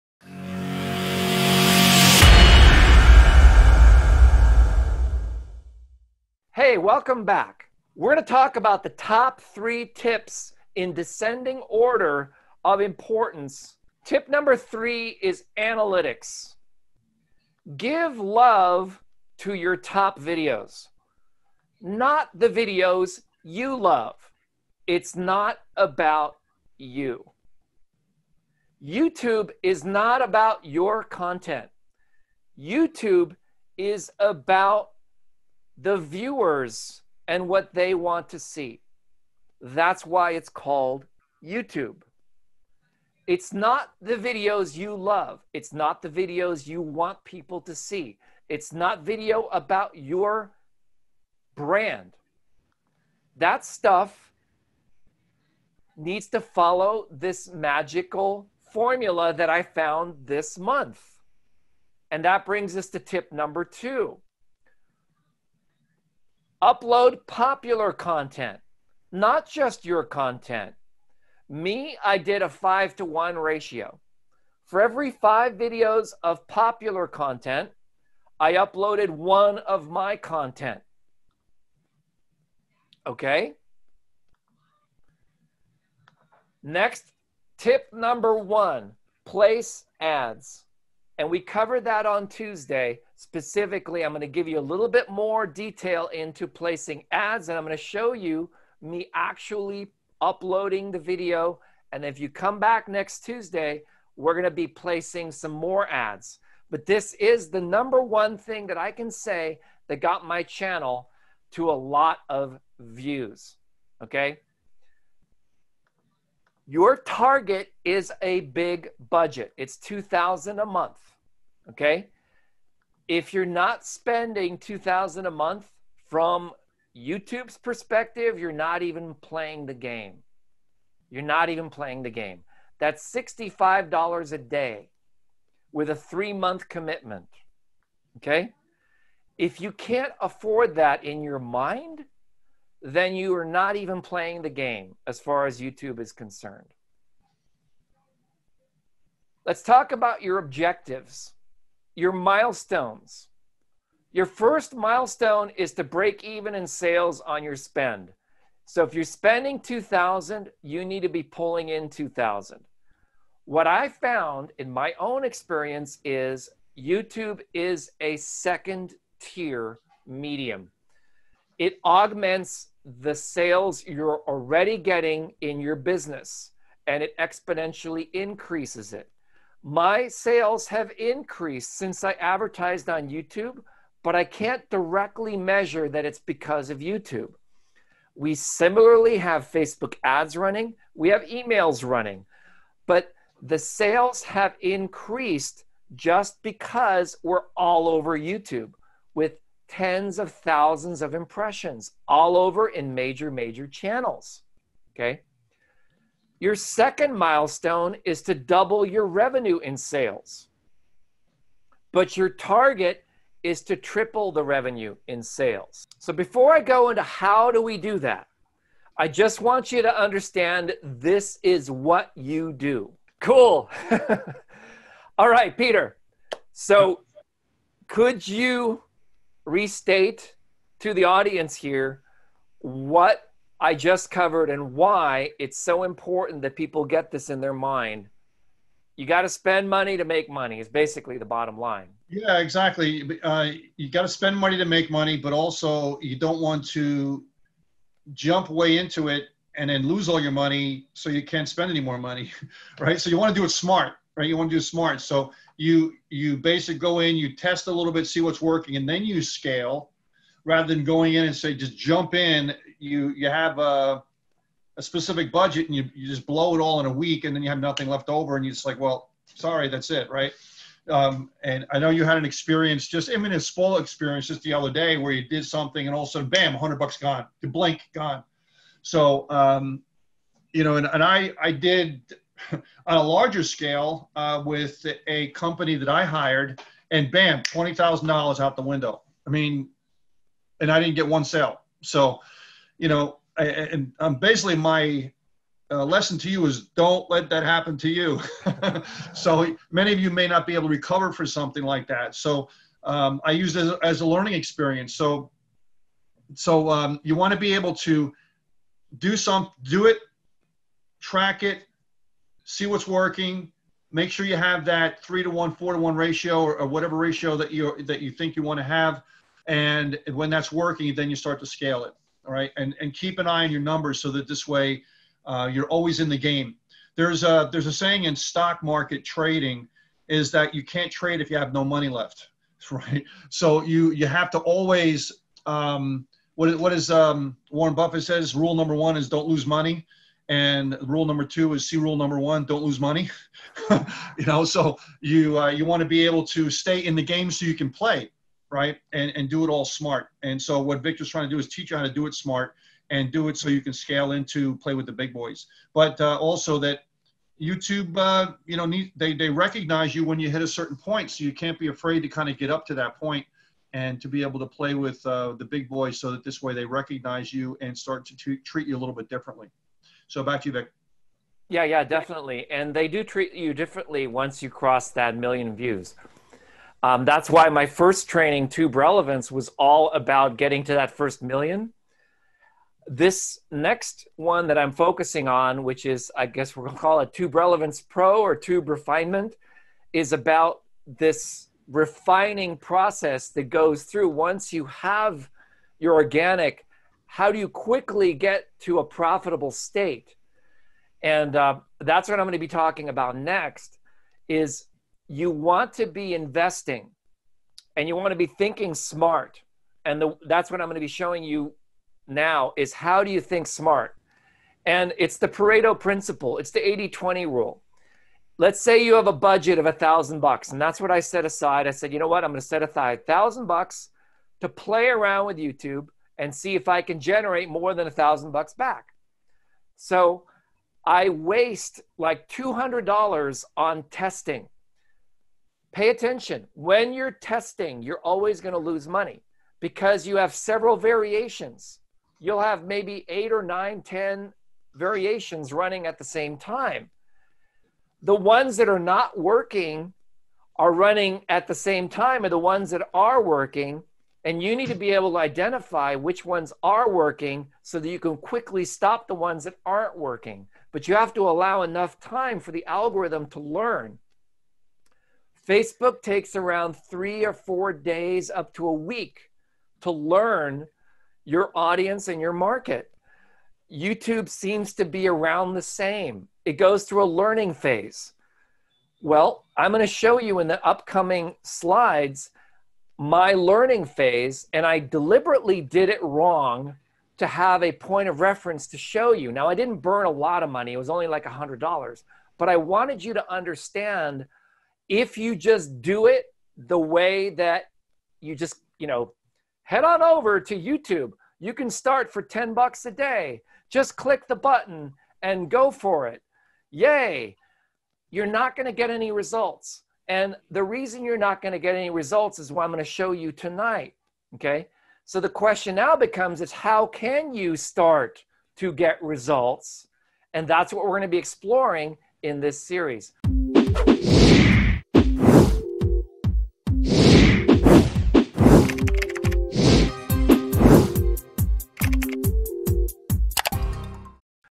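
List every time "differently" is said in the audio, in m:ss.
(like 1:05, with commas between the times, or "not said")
6:09, 6:13.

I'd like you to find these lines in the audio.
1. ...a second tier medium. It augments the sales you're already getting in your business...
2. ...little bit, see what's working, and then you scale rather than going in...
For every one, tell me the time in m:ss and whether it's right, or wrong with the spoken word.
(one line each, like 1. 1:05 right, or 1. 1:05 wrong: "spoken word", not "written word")
1. 2:47 right
2. 4:17 right.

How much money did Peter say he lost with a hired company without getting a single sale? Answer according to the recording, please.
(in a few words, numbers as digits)
$20,000.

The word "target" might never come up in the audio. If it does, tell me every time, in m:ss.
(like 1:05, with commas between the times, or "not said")
1:56, 3:32.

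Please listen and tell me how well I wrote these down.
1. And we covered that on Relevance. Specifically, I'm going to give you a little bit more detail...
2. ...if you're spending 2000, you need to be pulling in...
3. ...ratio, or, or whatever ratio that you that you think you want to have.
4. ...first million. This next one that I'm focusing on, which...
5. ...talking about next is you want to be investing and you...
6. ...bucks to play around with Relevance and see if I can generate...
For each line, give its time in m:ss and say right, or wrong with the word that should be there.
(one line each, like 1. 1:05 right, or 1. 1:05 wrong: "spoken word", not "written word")
1. 1:31 wrong: "Tuesday", not "Relevance"
2. 2:38 right
3. 5:15 right
4. 6:20 right
5. 6:42 right
6. 7:03 wrong: "YouTube", not "Relevance".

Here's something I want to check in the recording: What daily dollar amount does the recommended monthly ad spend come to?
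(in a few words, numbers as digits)
$65.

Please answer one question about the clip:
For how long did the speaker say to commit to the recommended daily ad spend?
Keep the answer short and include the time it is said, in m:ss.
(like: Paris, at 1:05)
3 months, at 2:15.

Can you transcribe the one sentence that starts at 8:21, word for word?
You can start for 10 bucks a day.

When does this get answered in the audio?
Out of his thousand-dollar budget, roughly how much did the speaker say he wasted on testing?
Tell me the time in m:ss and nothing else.
7:12.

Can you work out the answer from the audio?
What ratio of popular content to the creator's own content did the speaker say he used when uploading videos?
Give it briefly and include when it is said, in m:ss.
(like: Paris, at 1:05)
5 to 1, at 1:12.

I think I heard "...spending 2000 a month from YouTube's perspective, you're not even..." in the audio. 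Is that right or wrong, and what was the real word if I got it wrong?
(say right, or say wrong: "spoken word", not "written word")
right.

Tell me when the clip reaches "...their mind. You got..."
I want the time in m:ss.
3:57.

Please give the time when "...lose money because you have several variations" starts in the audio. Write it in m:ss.
7:18.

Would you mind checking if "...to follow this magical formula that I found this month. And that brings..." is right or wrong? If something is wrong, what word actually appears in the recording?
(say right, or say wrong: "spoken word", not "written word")
right.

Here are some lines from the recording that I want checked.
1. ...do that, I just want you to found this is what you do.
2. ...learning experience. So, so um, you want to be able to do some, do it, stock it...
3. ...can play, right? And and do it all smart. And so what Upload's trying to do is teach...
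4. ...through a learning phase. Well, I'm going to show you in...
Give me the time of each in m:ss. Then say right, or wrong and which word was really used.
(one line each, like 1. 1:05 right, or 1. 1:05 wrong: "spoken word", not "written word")
1. 3:37 wrong: "understand", not "found"
2. 5:04 wrong: "track", not "stock"
3. 5:47 wrong: "Victor", not "Upload"
4. 7:56 right.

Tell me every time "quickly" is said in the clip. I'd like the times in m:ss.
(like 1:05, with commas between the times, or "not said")
6:37, 7:38.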